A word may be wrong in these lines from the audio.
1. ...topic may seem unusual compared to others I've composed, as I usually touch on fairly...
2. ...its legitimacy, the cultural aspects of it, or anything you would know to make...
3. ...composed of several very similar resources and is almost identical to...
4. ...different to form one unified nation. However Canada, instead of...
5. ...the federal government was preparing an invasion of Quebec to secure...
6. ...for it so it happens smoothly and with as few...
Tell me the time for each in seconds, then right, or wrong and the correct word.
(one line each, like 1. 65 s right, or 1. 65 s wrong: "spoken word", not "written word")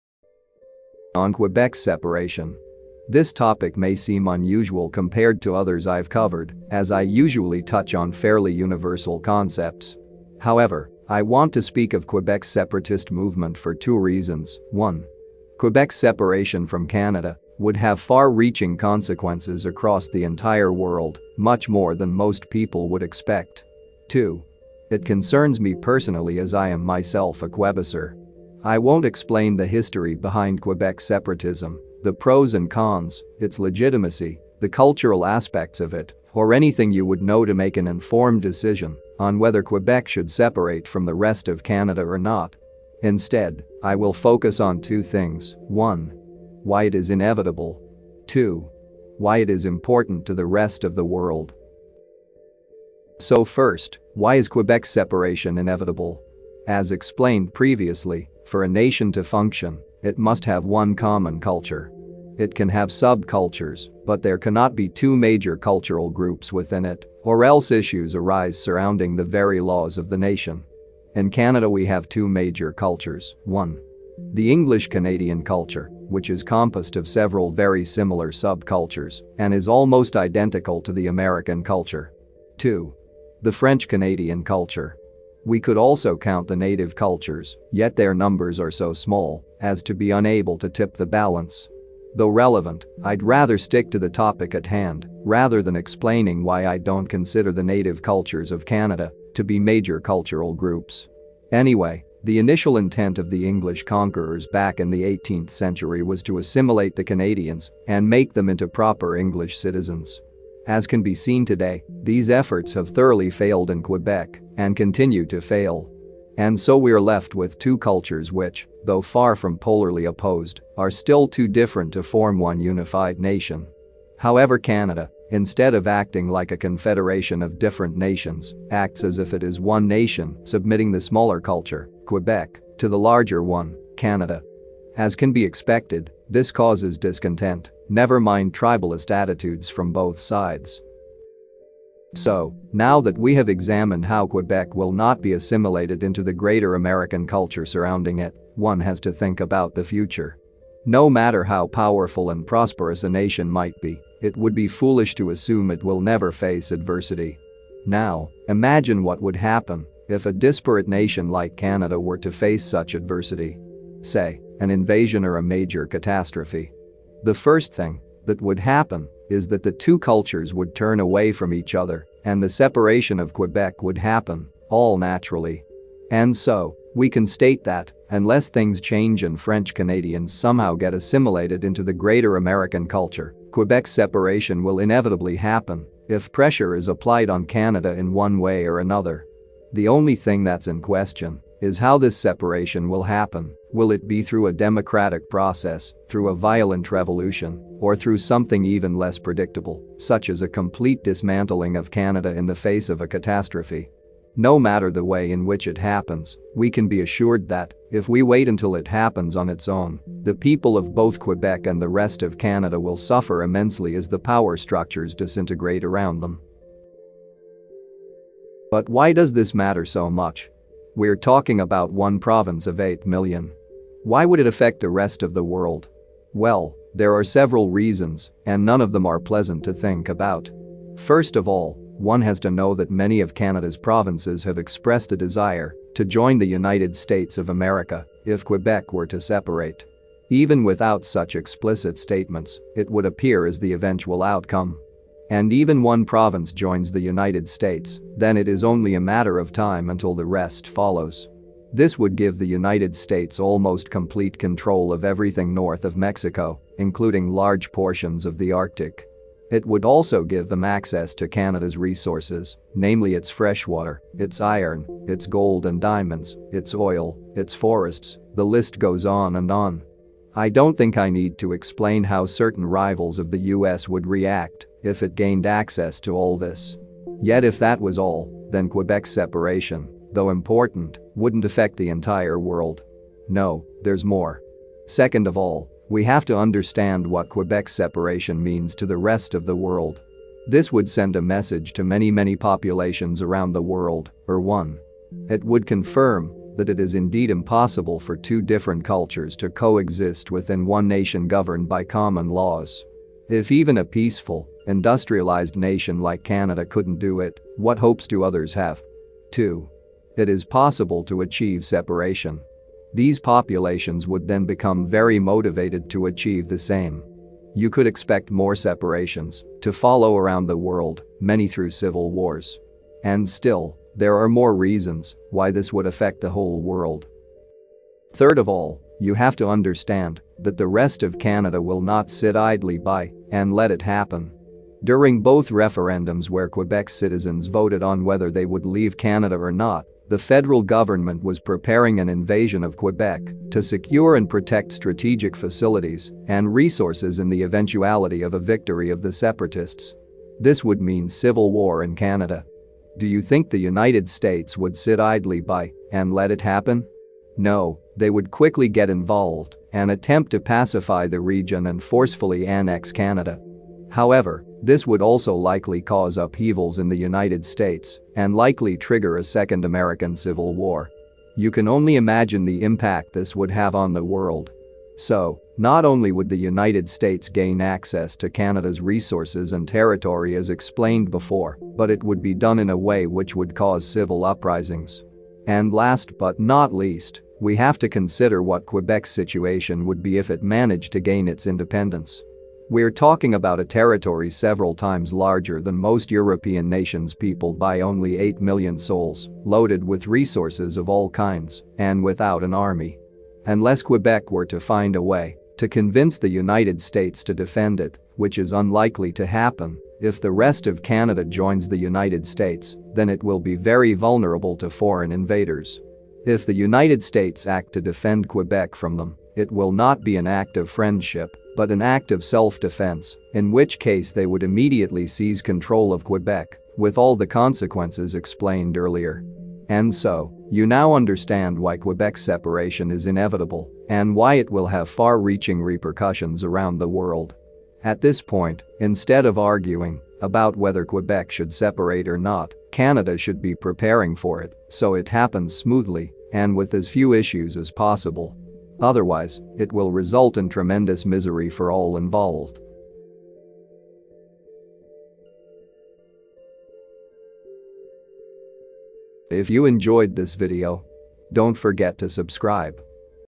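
1. 3 s wrong: "covered", not "composed"
2. 33 s right
3. 76 s wrong: "subcultures", not "resources"
4. 121 s right
5. 340 s right
6. 444 s right.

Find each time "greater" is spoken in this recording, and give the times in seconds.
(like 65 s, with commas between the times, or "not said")
146 s, 181 s.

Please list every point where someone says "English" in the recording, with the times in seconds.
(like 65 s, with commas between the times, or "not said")
74 s, 103 s, 109 s.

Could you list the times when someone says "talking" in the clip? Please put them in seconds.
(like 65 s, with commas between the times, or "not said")
221 s, 392 s.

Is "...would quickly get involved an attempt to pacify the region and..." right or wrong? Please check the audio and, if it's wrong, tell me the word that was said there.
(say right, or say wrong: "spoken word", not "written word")
right.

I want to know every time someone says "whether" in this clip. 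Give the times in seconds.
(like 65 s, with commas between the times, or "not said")
39 s, 338 s, 440 s.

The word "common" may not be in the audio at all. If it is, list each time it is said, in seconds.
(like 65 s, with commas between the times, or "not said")
60 s, 301 s.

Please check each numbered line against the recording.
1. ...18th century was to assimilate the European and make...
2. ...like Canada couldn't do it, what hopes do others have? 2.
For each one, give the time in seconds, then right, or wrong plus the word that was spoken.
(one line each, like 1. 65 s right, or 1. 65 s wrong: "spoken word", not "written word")
1. 105 s wrong: "Canadians", not "European"
2. 306 s right.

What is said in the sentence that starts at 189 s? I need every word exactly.
The only thing that's in question is how this separation will happen.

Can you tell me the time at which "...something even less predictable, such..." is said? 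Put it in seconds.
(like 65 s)
198 s.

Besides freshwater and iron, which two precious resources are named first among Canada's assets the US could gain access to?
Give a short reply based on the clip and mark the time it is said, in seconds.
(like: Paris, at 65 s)
gold and diamonds, at 265 s.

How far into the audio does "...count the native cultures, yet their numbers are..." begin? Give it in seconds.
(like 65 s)
86 s.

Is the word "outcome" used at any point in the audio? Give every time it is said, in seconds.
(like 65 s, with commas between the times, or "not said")
244 s.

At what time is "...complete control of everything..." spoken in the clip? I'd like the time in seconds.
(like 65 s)
253 s.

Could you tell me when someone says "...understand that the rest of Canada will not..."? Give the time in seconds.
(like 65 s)
329 s.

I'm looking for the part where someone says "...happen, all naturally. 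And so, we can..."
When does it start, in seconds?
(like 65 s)
173 s.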